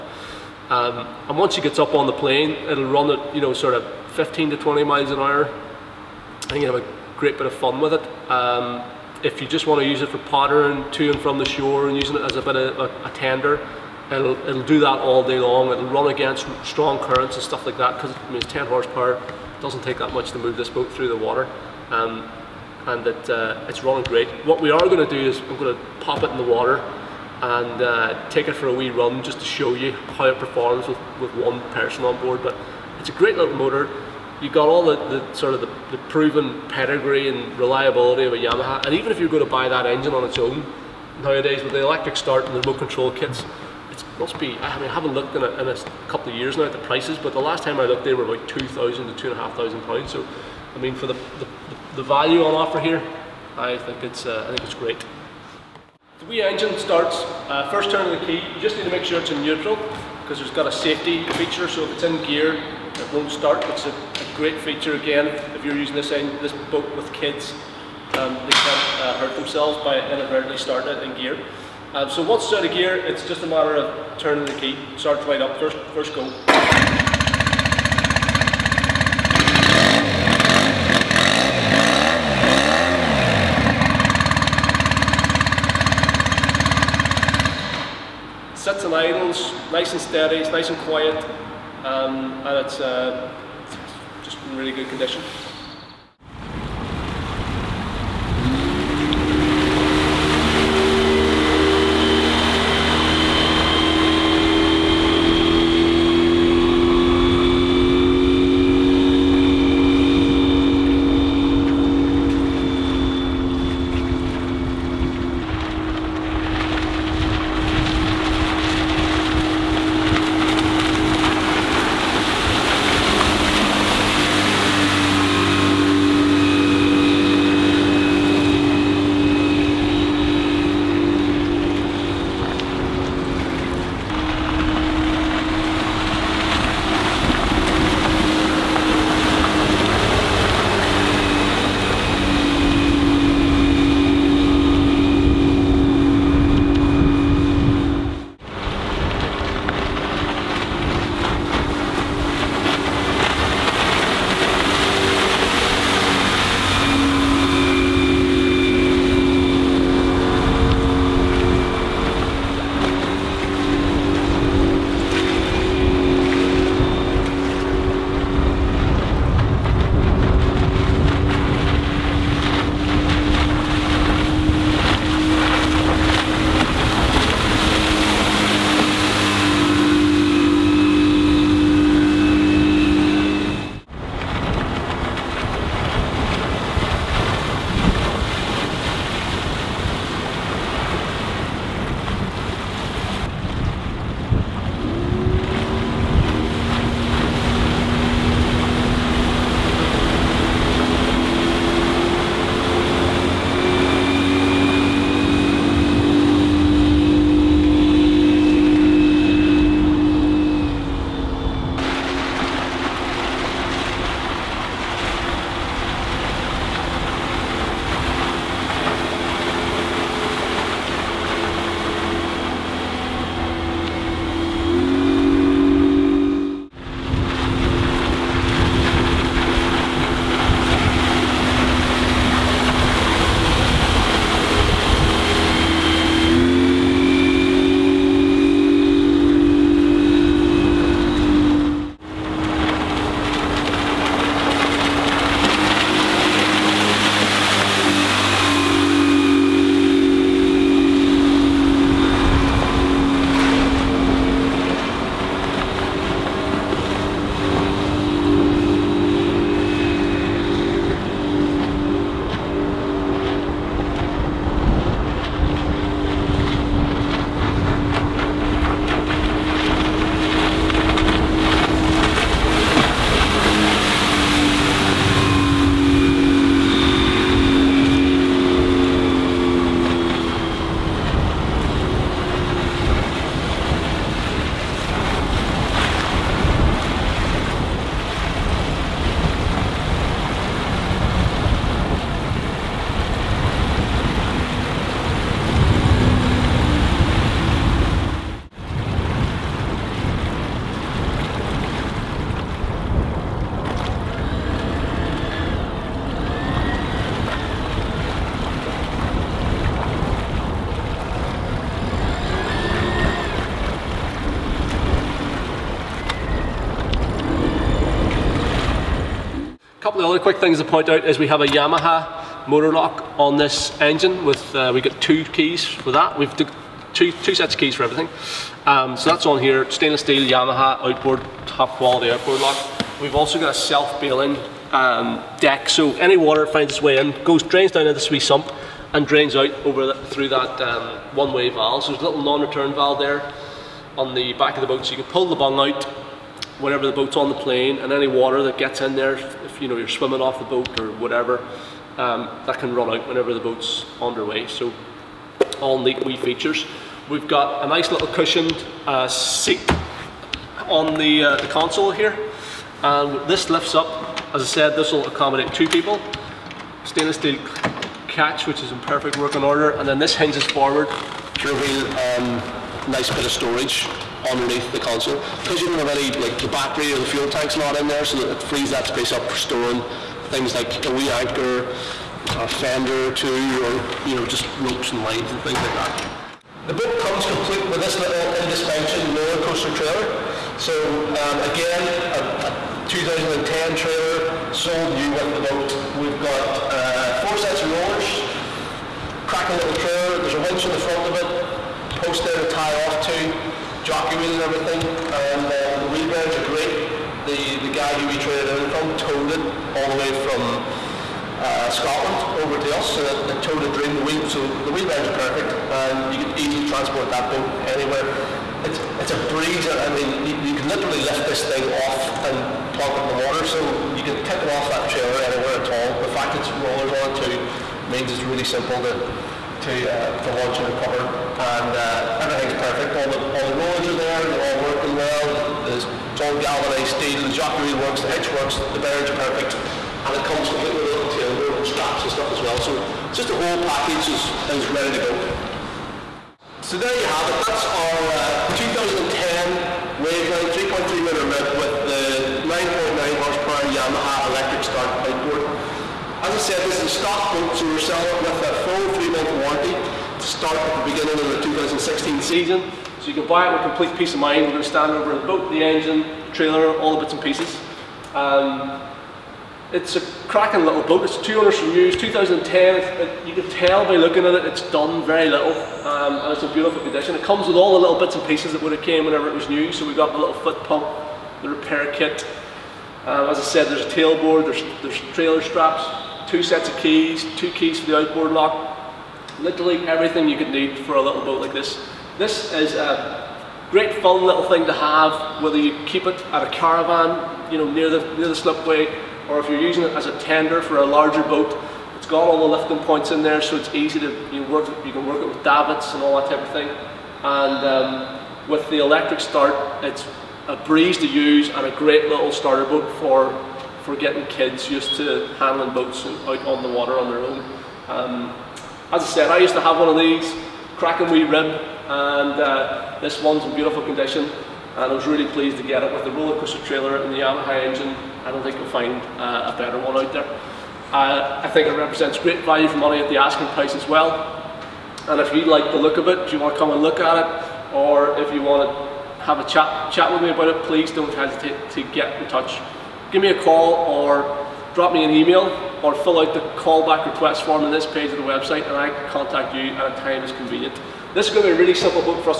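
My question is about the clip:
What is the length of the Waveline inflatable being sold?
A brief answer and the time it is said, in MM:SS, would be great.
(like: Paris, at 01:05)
3.3 meters, at 07:30.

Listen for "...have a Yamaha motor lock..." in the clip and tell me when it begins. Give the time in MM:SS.
05:21.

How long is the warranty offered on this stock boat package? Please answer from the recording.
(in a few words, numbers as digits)
3 months.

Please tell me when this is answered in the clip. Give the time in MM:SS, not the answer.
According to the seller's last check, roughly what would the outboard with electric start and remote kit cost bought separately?
00:48.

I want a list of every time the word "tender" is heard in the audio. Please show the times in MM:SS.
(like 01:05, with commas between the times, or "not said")
00:13, 08:20.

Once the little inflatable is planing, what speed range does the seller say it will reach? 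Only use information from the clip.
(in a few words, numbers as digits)
15 to 20 miles an hour.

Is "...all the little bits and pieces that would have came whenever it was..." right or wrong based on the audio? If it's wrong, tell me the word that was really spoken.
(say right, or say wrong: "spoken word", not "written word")
right.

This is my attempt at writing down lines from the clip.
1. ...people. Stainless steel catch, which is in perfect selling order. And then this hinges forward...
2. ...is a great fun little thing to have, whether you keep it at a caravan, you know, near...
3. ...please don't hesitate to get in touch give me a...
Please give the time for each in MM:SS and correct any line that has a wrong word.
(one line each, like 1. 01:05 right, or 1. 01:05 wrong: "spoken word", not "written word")
1. 06:05 wrong: "working", not "selling"
2. 08:12 right
3. 09:00 right.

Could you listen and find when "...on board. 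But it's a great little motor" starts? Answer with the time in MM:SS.
00:32.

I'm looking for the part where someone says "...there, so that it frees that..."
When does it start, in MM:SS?
06:17.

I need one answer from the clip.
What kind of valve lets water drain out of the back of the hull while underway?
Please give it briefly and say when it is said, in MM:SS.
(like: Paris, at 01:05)
non-return valve, at 05:42.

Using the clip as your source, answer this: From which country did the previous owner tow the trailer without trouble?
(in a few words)
Scotland.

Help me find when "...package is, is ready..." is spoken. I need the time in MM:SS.
07:23.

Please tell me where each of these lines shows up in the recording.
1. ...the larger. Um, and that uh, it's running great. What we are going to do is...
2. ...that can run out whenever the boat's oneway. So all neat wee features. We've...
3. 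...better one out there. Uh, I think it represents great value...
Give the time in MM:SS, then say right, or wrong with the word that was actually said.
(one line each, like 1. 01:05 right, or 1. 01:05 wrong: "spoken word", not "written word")
1. 00:21 wrong: "water", not "larger"
2. 05:52 wrong: "underway", not "oneway"
3. 08:49 right.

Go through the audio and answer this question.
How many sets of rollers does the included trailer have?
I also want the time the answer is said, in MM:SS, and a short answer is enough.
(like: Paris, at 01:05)
4, at 06:37.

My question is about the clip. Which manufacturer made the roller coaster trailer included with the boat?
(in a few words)
Indespension.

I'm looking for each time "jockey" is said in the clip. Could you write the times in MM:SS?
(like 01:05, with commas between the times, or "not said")
06:43, 07:17.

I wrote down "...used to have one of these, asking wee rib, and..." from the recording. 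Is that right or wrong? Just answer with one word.
wrong.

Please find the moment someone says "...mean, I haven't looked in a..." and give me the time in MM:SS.
00:44.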